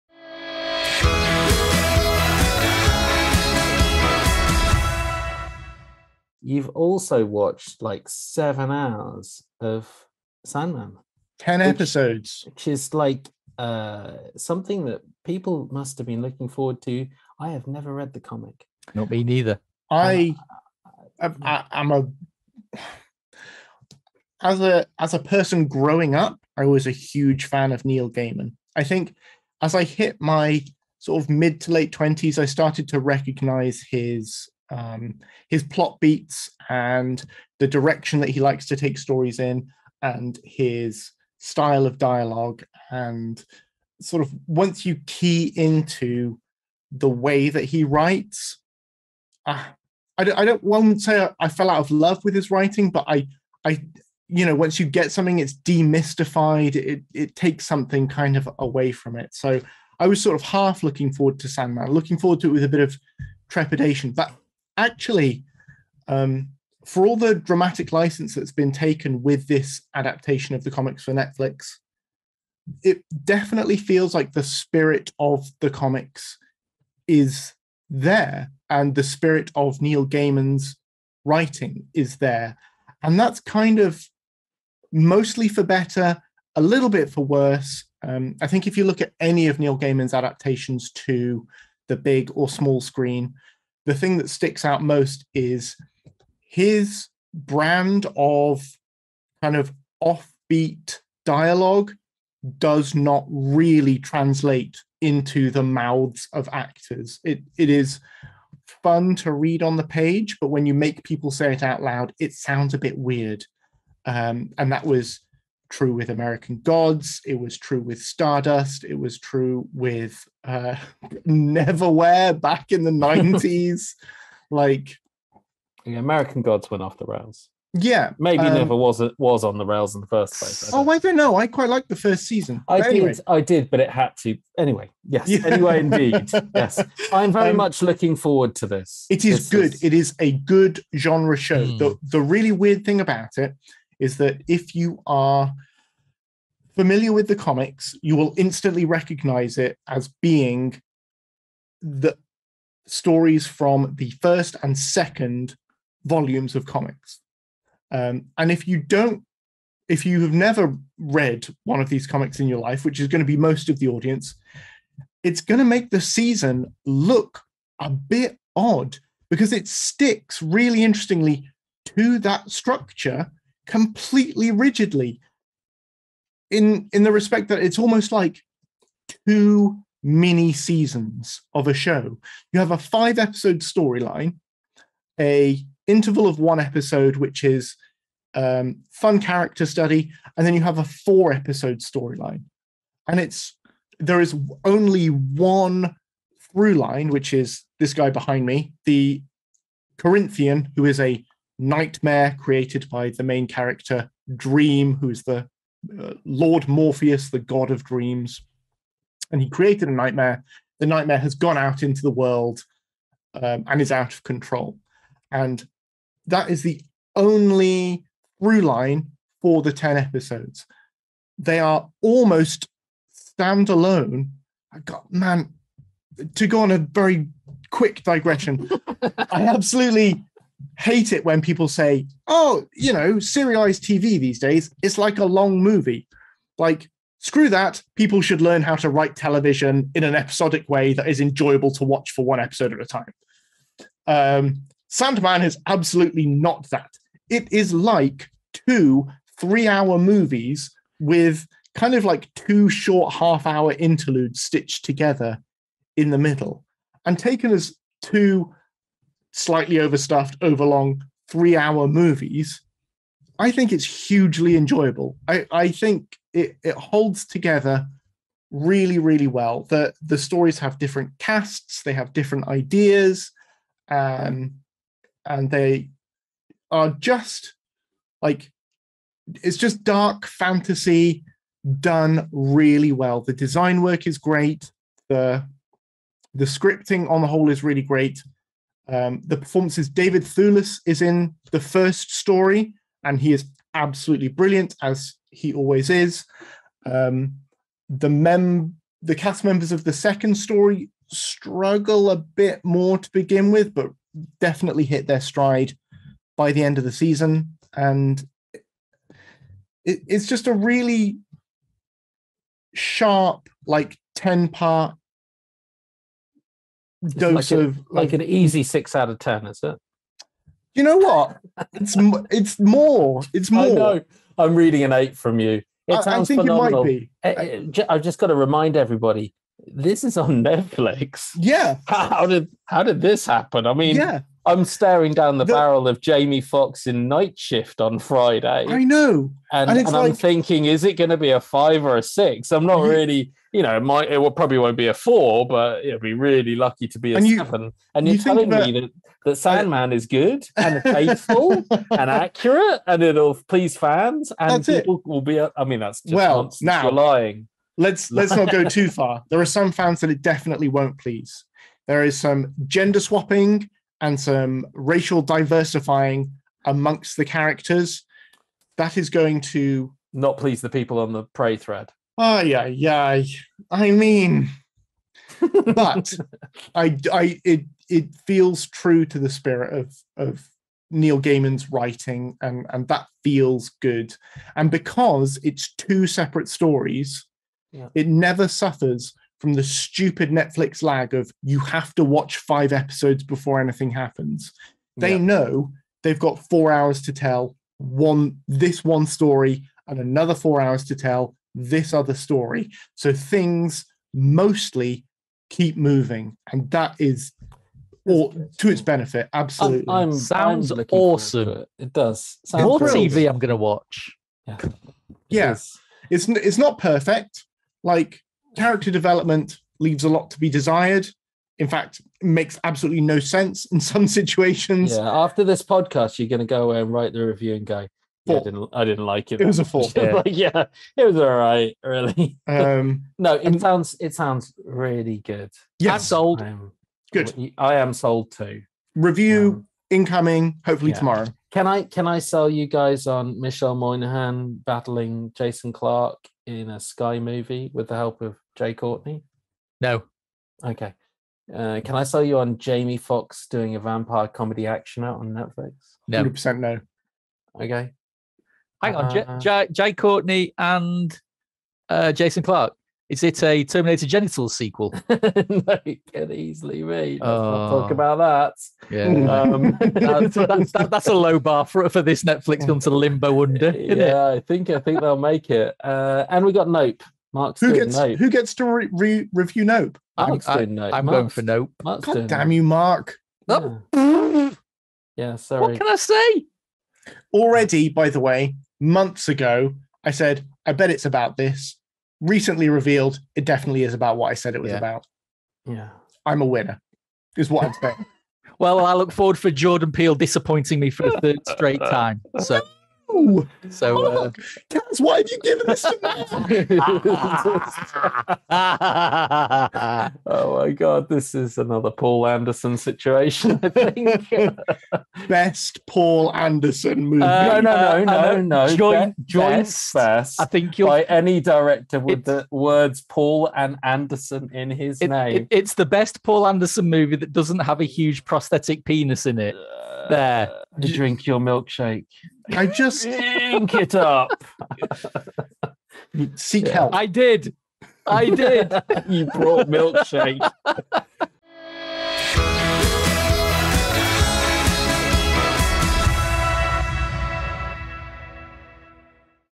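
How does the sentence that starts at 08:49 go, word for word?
Uh, there, To drink your milkshake.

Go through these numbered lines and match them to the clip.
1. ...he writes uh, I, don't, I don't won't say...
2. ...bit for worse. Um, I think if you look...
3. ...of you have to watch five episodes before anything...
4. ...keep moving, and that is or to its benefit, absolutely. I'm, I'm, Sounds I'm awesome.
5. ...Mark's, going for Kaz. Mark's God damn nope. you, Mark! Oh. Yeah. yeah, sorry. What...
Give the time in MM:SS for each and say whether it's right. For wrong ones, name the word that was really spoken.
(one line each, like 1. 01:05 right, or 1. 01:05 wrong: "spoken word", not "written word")
1. 00:47 right
2. 01:26 right
3. 06:31 right
4. 06:45 right
5. 08:01 wrong: "Nope", not "Kaz".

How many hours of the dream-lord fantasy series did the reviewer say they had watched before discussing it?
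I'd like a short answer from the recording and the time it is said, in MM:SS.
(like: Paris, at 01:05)
7, at 00:08.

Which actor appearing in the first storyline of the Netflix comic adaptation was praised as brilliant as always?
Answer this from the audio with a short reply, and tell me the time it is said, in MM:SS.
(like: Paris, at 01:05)
David Thewlis, at 04:49.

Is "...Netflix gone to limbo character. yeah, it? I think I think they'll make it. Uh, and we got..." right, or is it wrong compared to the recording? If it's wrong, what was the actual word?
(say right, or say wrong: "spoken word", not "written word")
wrong: "under", not "character".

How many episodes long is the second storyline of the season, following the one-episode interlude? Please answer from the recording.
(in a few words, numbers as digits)
4.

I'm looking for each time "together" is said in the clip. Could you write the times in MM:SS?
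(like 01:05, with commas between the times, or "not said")
04:14, 04:27.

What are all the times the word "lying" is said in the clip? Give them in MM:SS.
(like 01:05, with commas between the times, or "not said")
05:56.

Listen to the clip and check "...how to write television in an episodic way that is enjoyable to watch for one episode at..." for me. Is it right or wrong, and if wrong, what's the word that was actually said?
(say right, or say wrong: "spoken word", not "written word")
right.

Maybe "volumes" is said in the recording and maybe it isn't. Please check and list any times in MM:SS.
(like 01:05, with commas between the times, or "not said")
02:36.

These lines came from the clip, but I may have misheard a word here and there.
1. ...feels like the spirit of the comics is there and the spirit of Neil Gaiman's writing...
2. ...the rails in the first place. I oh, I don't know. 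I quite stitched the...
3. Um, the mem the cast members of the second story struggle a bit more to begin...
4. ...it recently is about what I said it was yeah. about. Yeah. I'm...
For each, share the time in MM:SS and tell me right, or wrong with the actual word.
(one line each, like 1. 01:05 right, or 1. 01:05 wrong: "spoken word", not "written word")
1. 01:13 right
2. 02:09 wrong: "liked", not "stitched"
3. 04:56 right
4. 08:13 wrong: "definitely", not "recently".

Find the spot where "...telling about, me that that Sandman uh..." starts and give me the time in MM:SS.
05:48.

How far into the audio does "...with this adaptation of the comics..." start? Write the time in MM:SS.
01:09.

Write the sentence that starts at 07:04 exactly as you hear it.
Yeah, after this podcast, you're going to go away and write the review and go, yeah, I, didn't, I didn't like it.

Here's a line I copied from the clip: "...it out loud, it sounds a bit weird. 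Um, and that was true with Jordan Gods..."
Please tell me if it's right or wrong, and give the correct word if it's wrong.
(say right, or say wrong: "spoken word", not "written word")
wrong: "American", not "Jordan".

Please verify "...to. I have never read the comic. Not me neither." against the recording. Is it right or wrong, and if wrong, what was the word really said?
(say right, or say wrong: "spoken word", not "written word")
right.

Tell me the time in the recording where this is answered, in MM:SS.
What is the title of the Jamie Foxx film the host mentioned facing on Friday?
05:37.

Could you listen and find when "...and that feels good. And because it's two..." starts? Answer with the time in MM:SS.
06:22.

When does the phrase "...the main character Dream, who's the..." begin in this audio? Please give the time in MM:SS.
03:23.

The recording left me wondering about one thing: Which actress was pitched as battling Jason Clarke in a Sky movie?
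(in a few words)
Michelle Monaghan.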